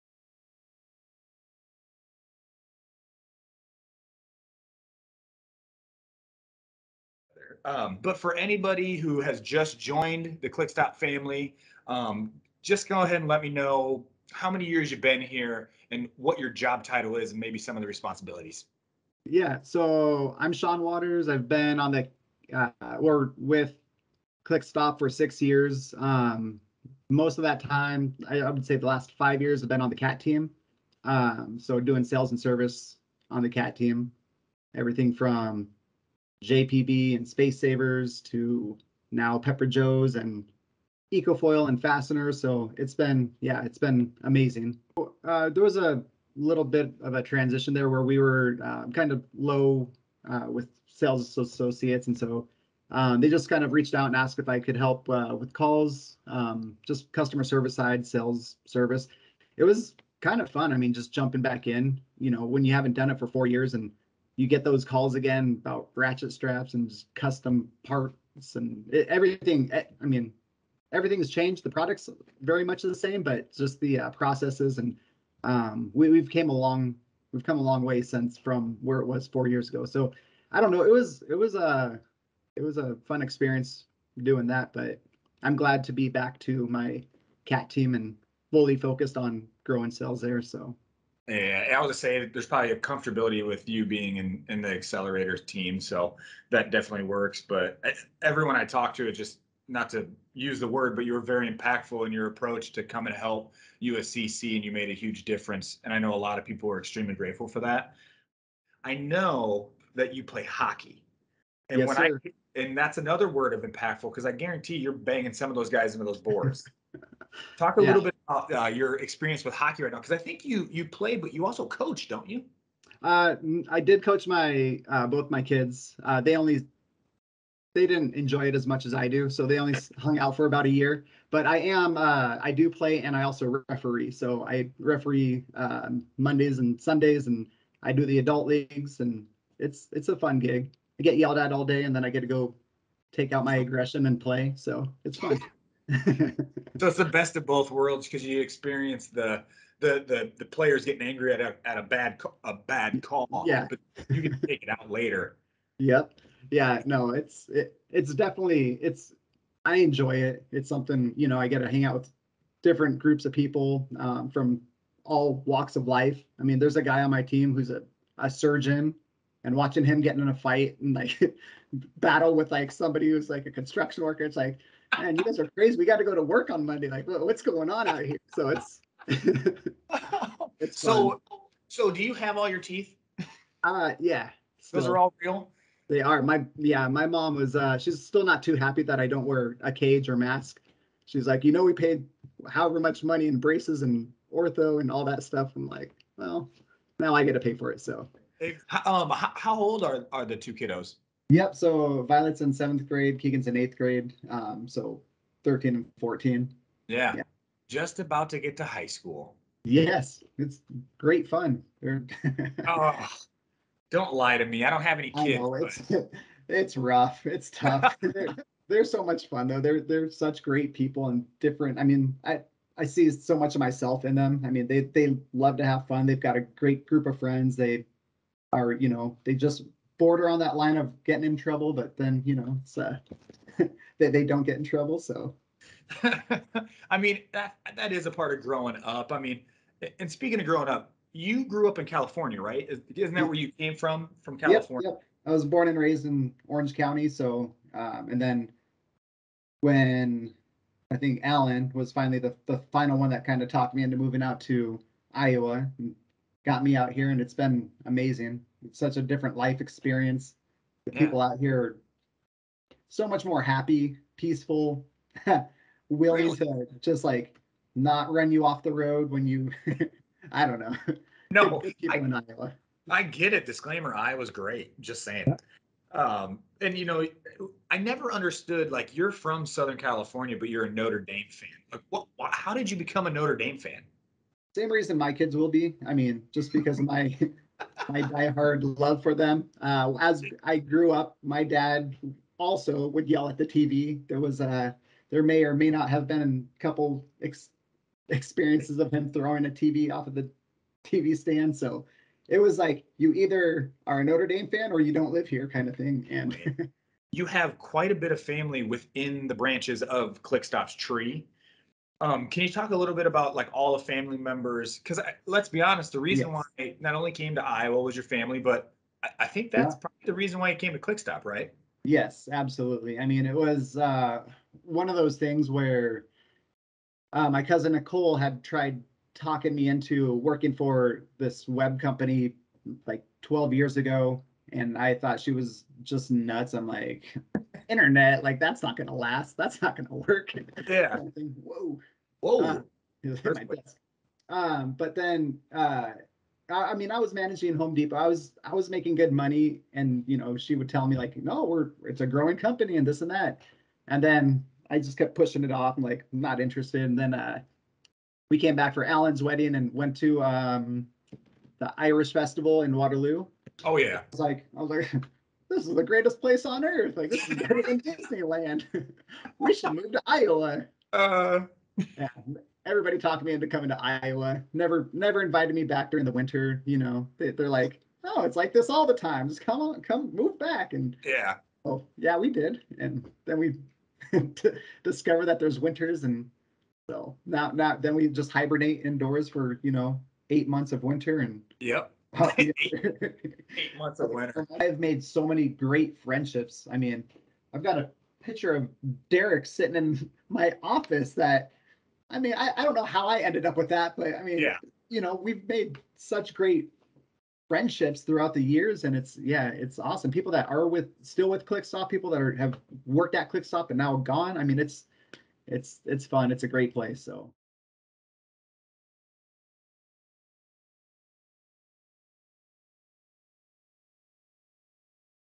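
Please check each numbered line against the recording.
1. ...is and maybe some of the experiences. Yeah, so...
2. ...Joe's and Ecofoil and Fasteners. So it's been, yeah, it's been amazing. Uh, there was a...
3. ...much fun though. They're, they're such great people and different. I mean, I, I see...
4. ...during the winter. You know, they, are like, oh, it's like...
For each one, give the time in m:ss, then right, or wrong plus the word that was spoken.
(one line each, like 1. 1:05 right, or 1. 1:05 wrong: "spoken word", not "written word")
1. 0:17 wrong: "responsibilities", not "experiences"
2. 0:39 right
3. 3:39 right
4. 6:15 right.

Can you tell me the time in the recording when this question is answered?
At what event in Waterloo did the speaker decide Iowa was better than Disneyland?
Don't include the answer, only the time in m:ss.
6:01.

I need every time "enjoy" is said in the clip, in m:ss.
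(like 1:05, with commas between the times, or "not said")
2:08, 2:39.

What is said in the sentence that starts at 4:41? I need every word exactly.
Like, what, what, how did you become a Notre Dame fan?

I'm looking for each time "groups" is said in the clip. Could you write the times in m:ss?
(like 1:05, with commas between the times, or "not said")
2:42, 3:46.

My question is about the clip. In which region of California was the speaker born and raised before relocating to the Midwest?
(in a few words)
Orange County.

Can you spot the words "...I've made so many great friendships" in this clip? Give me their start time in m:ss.
6:34.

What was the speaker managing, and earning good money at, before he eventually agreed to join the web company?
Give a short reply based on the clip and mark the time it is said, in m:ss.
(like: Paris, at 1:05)
Home Depot, at 5:47.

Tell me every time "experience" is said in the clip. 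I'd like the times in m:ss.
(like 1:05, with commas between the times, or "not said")
1:23, 1:58, 2:28, 4:19, 4:58.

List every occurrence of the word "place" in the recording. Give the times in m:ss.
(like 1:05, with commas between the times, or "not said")
6:06, 6:56.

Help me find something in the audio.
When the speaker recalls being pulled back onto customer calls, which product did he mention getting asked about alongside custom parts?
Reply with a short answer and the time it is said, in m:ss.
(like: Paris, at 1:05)
ratchet straps, at 1:05.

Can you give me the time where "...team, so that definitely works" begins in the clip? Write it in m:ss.
1:35.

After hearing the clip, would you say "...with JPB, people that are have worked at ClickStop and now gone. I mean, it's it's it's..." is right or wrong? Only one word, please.
wrong.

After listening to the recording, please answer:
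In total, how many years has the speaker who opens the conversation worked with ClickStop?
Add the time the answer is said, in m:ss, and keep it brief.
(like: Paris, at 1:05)
6, at 0:25.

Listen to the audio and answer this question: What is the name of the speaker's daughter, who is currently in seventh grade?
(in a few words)
Violet.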